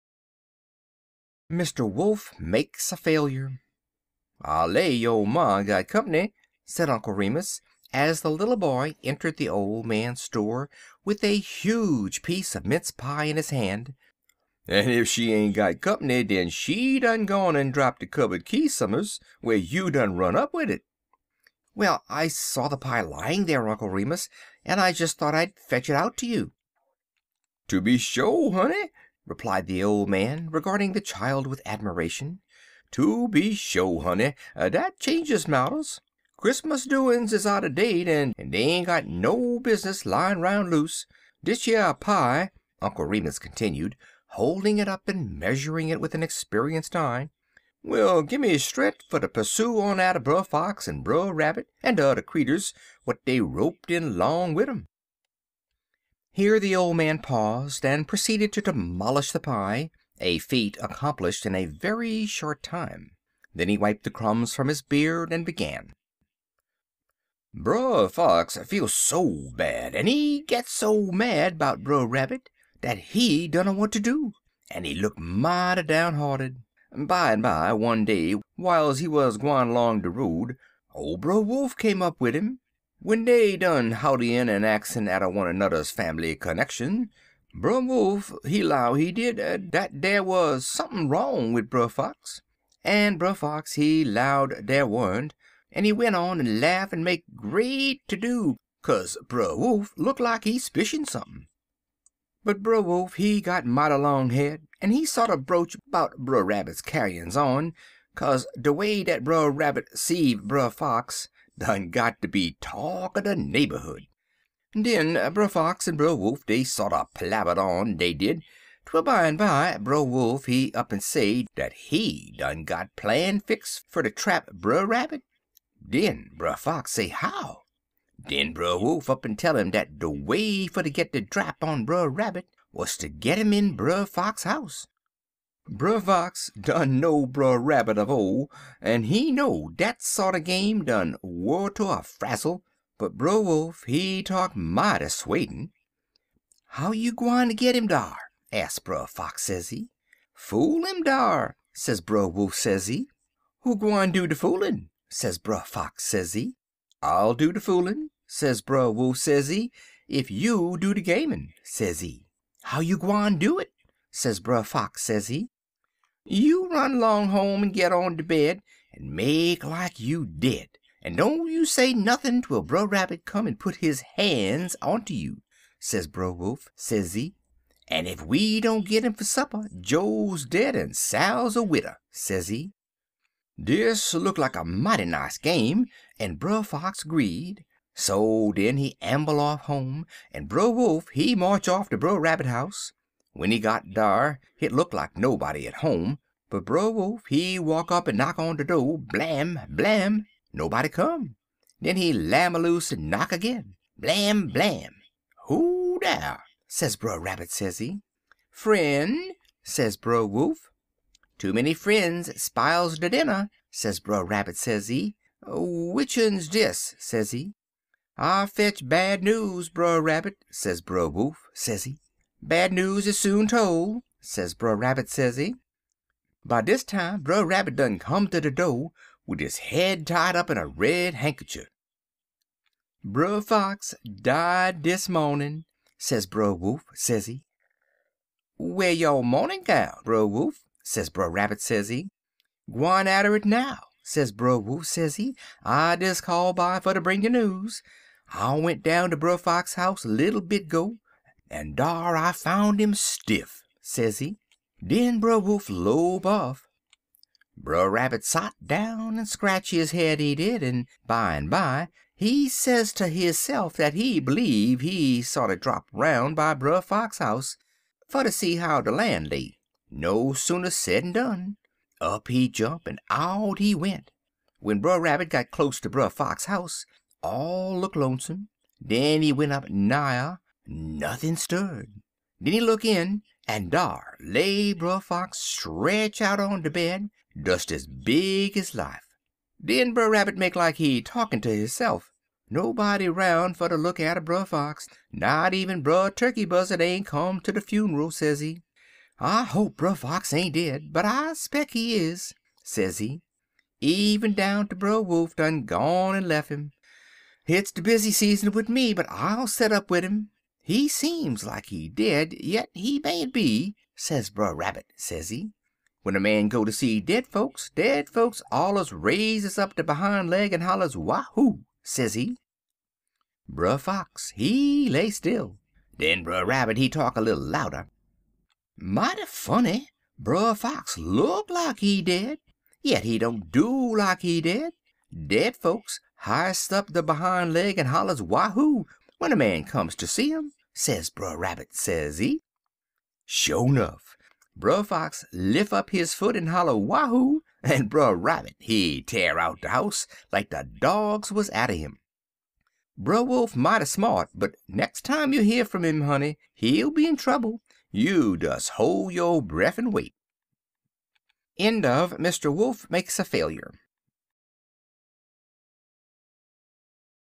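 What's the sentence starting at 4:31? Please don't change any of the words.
Up he jump, en out he went.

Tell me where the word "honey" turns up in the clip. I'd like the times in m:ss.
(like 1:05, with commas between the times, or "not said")
0:28, 0:33, 5:56.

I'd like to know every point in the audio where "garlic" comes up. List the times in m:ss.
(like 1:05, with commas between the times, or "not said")
not said.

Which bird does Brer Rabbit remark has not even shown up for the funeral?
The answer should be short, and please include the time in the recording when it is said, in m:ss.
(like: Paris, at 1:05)
Brer Turkey Buzzard, at 4:55.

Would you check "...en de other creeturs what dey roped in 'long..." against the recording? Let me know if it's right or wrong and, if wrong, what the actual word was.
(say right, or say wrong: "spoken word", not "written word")
right.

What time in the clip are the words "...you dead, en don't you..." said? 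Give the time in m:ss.
2:49.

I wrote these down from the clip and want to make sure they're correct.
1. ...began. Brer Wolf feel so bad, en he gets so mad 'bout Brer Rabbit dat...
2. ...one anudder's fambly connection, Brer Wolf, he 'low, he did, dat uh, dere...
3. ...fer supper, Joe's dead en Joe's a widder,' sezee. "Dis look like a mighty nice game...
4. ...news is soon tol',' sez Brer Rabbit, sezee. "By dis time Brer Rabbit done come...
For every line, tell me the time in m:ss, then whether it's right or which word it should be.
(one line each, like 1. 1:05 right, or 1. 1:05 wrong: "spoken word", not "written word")
1. 1:05 wrong: "Fox", not "Wolf"
2. 1:25 right
3. 2:59 wrong: "Sal", not "Joe"
4. 3:42 right.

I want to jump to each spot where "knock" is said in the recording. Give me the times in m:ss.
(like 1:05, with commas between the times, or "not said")
3:18, 3:23.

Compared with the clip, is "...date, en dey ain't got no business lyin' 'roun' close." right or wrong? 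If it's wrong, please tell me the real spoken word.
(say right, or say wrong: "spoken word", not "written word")
wrong: "loose", not "close".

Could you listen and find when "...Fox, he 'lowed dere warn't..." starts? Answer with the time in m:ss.
1:33.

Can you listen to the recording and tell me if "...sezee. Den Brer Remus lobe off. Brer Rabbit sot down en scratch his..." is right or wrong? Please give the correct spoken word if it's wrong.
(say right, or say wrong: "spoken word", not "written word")
wrong: "Wolf", not "Remus".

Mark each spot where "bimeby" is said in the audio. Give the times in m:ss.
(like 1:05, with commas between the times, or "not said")
1:16, 1:59, 4:21.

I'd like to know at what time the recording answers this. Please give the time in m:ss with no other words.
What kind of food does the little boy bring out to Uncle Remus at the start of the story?
0:12.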